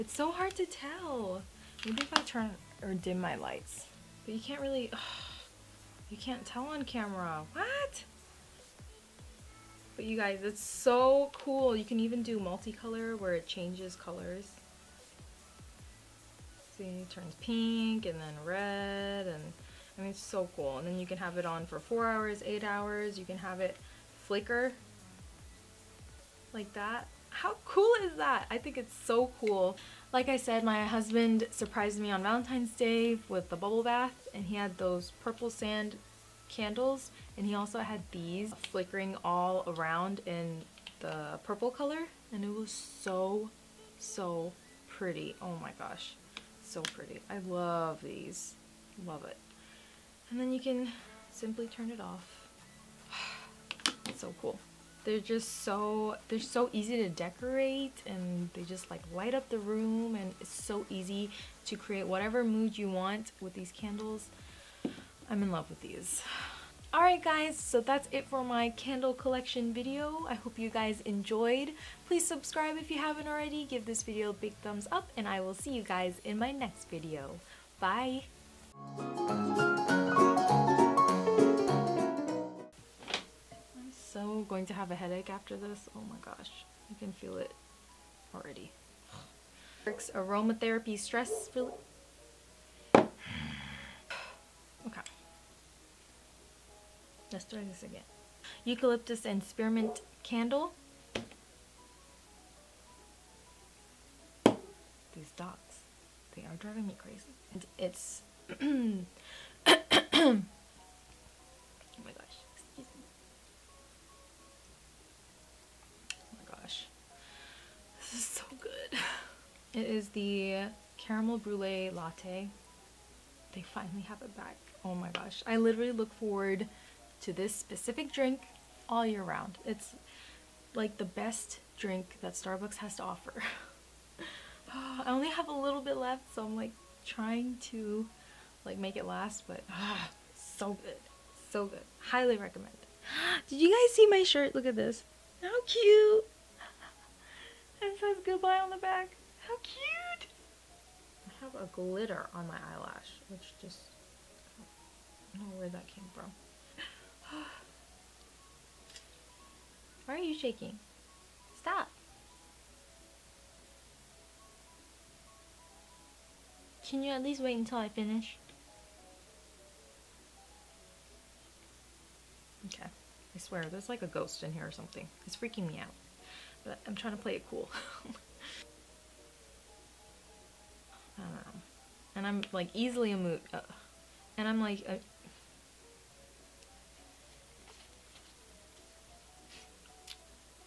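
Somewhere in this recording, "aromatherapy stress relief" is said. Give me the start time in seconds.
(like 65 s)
89 s.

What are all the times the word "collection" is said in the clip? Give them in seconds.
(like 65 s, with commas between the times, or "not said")
69 s.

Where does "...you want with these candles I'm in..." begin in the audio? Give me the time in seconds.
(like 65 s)
62 s.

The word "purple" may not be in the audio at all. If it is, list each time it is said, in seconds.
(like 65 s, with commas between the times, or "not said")
35 s, 41 s.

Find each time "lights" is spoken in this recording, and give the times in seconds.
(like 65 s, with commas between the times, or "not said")
3 s, 59 s.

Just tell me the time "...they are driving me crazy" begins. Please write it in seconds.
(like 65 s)
106 s.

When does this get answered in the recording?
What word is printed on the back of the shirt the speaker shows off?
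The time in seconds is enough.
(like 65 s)
148 s.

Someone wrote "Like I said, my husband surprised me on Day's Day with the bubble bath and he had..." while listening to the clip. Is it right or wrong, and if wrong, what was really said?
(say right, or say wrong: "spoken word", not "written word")
wrong: "Valentine", not "Day".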